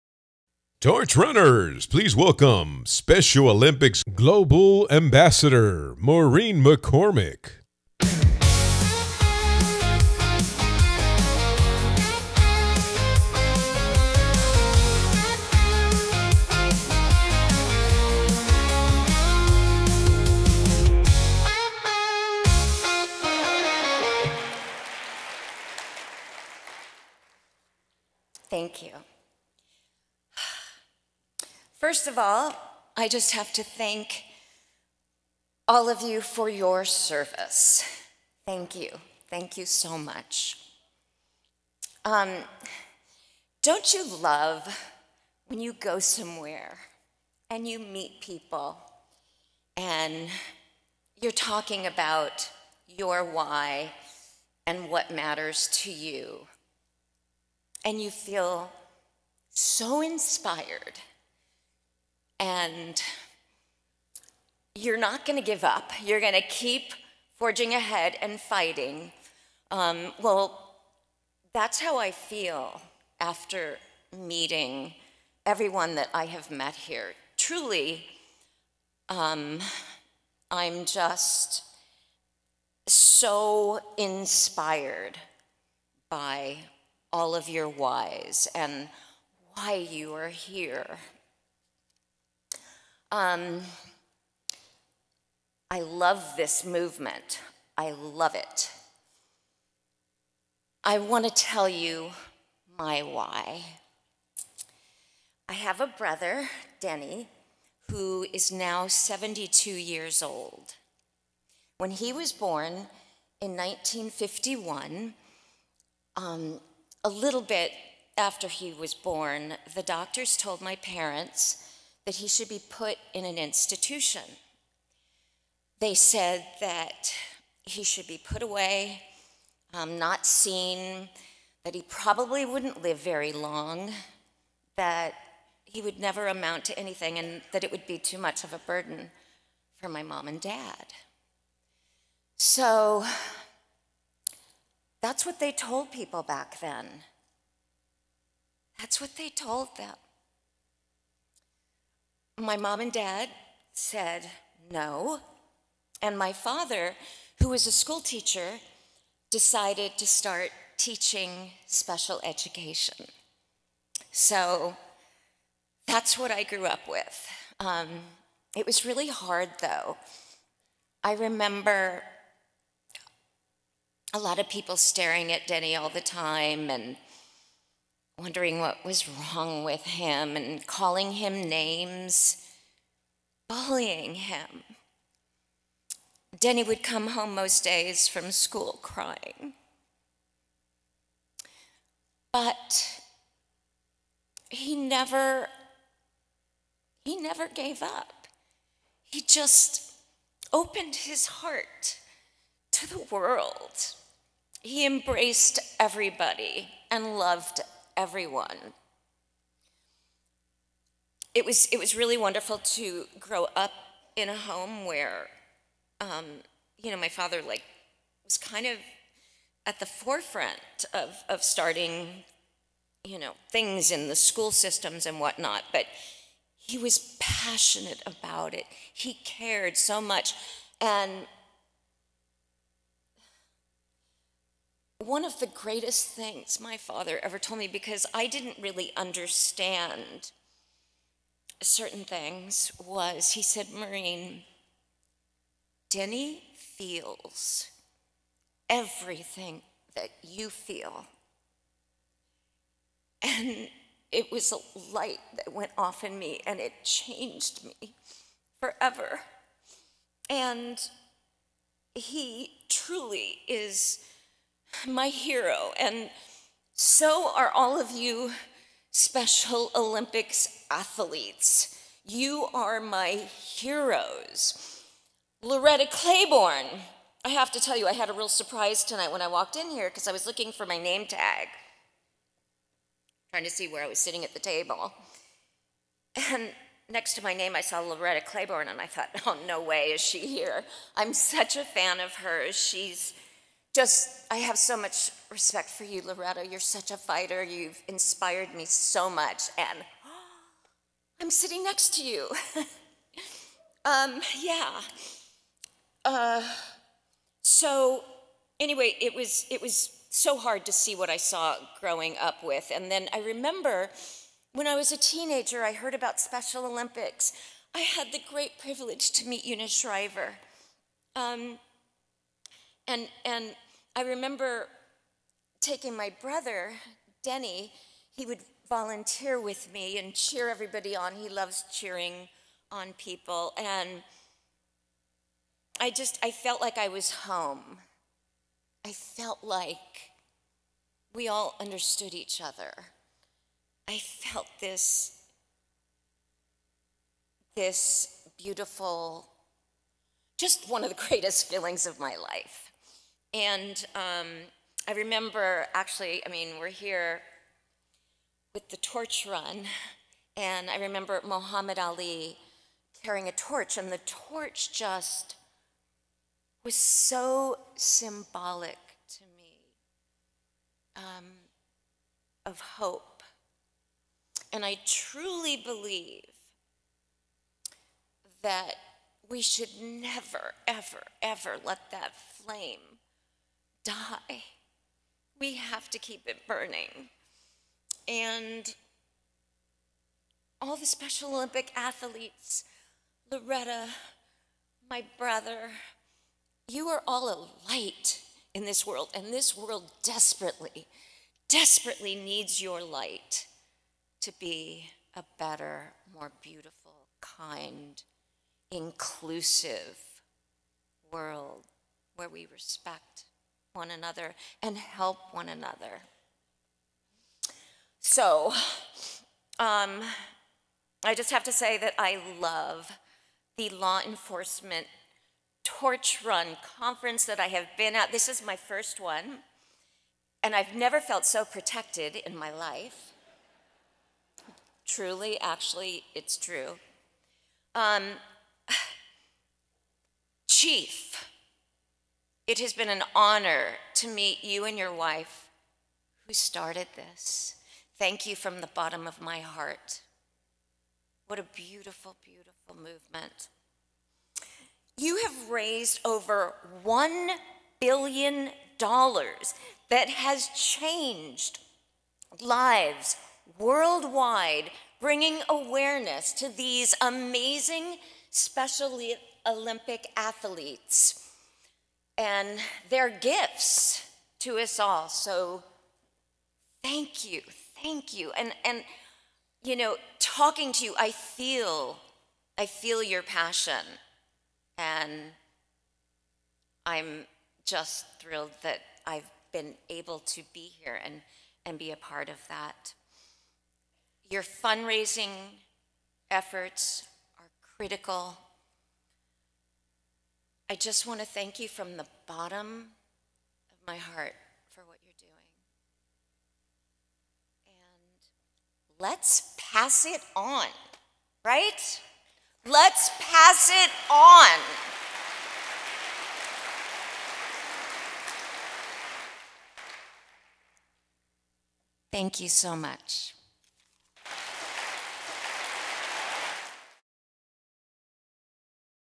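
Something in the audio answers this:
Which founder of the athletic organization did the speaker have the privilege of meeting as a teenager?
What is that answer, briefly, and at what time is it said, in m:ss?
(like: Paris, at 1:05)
Eunice Shriver, at 5:19.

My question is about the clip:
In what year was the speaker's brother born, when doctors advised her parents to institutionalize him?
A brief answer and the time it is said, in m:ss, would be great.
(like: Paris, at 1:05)
1951, at 1:53.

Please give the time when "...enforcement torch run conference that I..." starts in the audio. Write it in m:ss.
7:04.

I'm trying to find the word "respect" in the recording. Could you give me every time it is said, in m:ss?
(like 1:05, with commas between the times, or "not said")
4:55, 6:52.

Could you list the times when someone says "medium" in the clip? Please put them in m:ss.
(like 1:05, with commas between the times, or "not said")
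not said.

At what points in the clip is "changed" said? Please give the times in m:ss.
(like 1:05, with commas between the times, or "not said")
4:16, 7:40.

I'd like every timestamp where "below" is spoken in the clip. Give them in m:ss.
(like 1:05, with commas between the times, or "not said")
not said.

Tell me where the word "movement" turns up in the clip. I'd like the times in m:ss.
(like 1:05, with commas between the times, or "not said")
1:36, 7:32.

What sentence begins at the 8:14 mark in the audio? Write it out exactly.
Your fundraising efforts are critical I just want to thank you from the bottom of my heart for what you're doing.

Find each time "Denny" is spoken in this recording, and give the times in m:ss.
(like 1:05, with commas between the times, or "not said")
1:46, 2:55, 3:06, 4:05, 5:27.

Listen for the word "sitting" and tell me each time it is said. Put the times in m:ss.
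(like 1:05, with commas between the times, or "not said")
4:43, 5:01.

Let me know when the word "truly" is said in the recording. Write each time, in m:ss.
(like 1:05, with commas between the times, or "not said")
1:17, 4:22, 6:14, 7:14.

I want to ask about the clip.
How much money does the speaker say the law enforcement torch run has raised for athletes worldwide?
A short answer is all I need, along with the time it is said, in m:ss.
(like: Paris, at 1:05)
$1 billion, at 7:36.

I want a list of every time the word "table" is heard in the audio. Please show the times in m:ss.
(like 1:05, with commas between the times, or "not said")
4:44.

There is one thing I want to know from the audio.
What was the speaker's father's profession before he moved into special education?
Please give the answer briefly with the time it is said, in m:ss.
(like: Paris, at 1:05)
School teacher, at 2:37.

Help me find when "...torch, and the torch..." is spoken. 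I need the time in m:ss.
6:03.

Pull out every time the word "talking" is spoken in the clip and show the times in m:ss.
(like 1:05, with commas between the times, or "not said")
0:51, 8:00.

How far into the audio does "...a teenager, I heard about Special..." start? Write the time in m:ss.
5:14.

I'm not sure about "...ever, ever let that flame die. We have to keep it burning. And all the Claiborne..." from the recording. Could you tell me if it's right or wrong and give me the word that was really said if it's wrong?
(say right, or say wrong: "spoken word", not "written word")
wrong: "Special", not "Claiborne".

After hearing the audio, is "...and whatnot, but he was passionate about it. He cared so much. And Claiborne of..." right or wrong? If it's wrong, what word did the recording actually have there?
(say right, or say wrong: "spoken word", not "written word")
wrong: "One", not "Claiborne".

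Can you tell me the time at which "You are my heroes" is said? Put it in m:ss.
4:32.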